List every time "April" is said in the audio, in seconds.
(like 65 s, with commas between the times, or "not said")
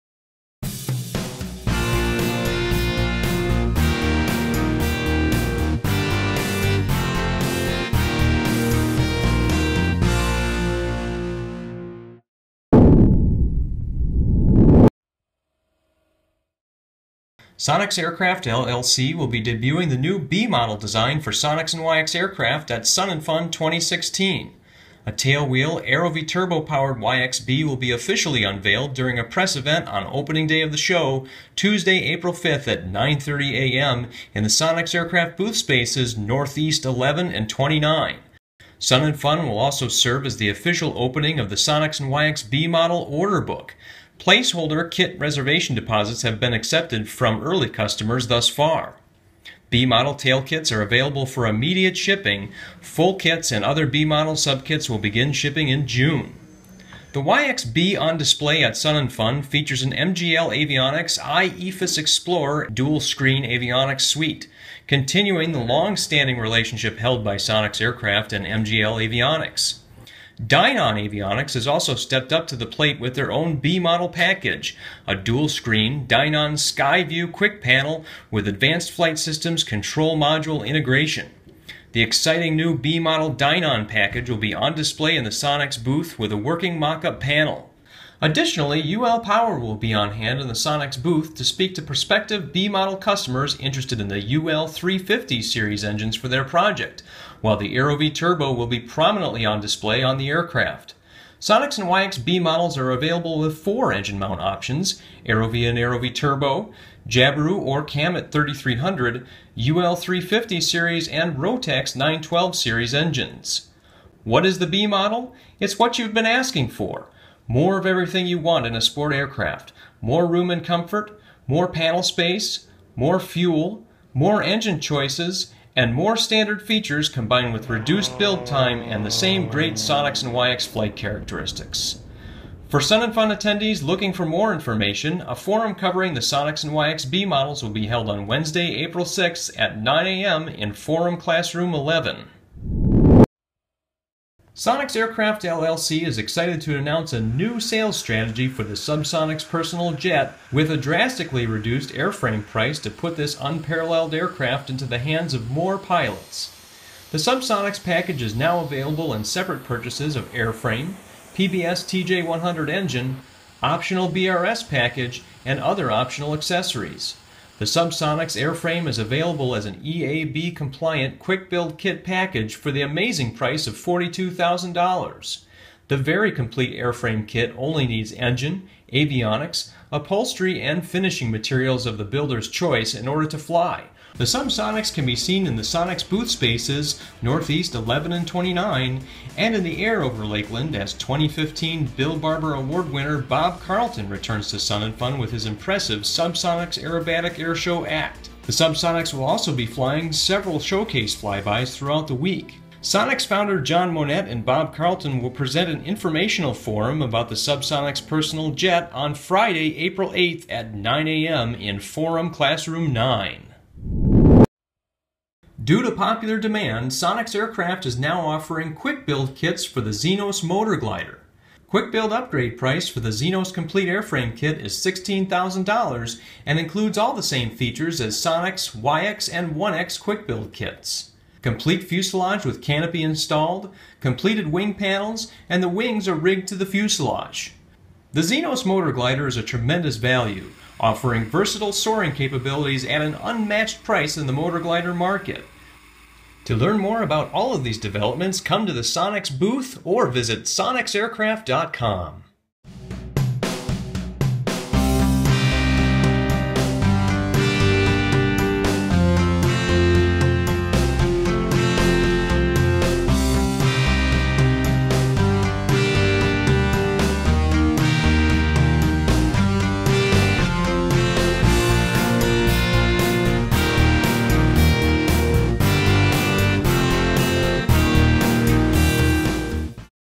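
32 s, 138 s, 209 s.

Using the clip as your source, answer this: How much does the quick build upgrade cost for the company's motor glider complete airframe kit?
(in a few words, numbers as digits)
$16,000.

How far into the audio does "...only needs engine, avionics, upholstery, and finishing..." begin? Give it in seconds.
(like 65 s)
177 s.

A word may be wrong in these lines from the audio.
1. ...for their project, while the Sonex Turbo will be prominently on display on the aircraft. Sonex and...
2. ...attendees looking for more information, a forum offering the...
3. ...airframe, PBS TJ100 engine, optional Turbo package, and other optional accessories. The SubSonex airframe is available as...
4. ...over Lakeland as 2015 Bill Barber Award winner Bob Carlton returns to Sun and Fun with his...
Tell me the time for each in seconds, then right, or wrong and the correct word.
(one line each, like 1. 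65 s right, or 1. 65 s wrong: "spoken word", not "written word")
1. 96 s wrong: "AeroVee", not "Sonex"
2. 133 s wrong: "covering", not "offering"
3. 160 s wrong: "BRS", not "Turbo"
4. 190 s right.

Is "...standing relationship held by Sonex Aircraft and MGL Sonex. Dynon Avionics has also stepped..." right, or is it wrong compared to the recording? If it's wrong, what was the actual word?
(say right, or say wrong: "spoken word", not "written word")
wrong: "Avionics", not "Sonex".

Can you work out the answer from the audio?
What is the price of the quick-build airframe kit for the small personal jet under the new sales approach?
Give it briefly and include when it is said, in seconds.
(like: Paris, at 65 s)
$42,000, at 173 s.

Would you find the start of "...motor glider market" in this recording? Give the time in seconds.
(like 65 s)
244 s.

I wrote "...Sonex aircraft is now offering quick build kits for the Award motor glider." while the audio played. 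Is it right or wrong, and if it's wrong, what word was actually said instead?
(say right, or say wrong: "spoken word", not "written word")
wrong: "Xenos", not "Award".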